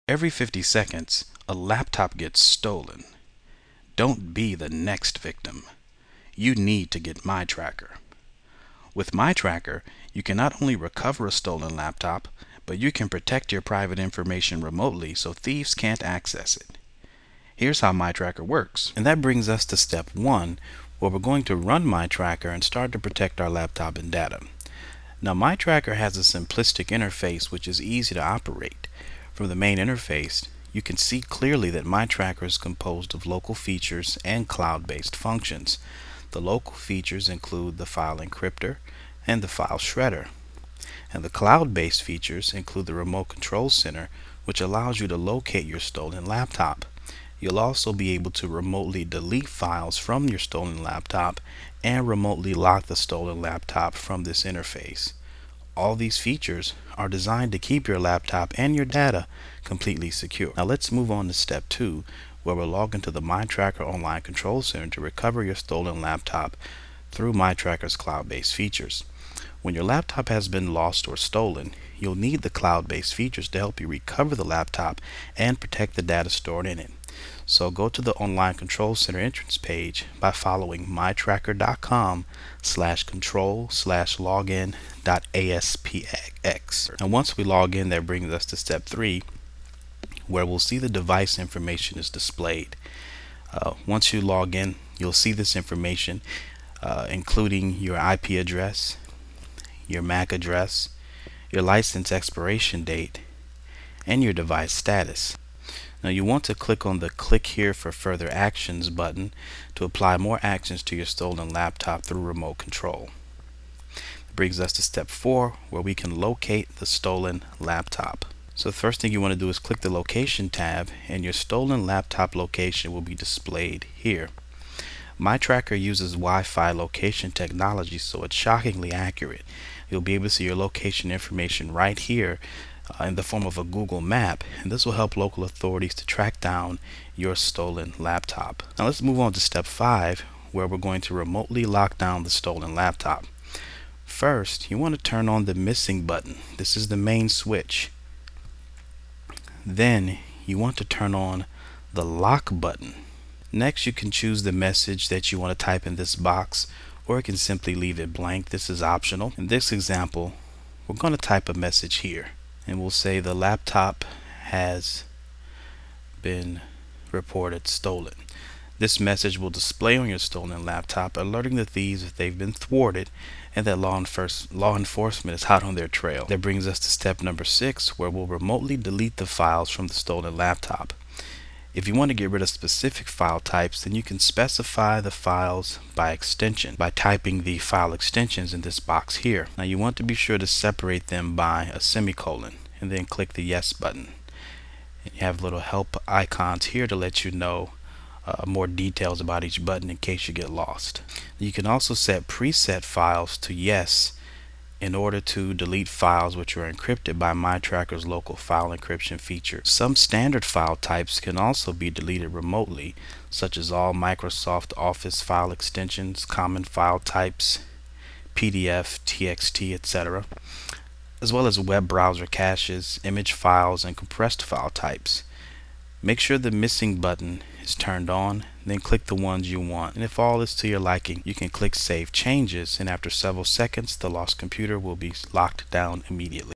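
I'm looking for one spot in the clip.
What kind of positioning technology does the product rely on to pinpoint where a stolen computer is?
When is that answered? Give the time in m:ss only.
2:06.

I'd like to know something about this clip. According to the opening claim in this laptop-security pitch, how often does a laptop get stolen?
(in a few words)
Every 50 seconds.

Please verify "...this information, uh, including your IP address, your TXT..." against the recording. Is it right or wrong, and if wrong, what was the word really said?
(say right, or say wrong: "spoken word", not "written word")
wrong: "MAC", not "TXT".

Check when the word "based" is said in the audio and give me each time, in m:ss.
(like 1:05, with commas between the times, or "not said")
0:34, 0:41, 1:07, 1:12.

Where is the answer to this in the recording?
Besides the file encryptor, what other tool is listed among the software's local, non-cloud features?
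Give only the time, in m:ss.
0:39.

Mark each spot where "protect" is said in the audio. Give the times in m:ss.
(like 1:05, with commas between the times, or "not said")
0:13, 0:22, 1:15.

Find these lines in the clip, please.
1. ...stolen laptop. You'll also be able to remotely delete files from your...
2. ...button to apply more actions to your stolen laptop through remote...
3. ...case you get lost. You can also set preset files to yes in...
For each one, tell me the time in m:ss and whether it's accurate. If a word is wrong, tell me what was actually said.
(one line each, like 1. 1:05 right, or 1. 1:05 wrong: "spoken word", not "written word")
1. 0:45 right
2. 1:48 right
3. 3:19 right.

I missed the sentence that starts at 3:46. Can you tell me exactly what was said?
Make sure the missing button is turned on, then click the ones you want.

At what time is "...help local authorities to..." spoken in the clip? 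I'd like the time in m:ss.
2:14.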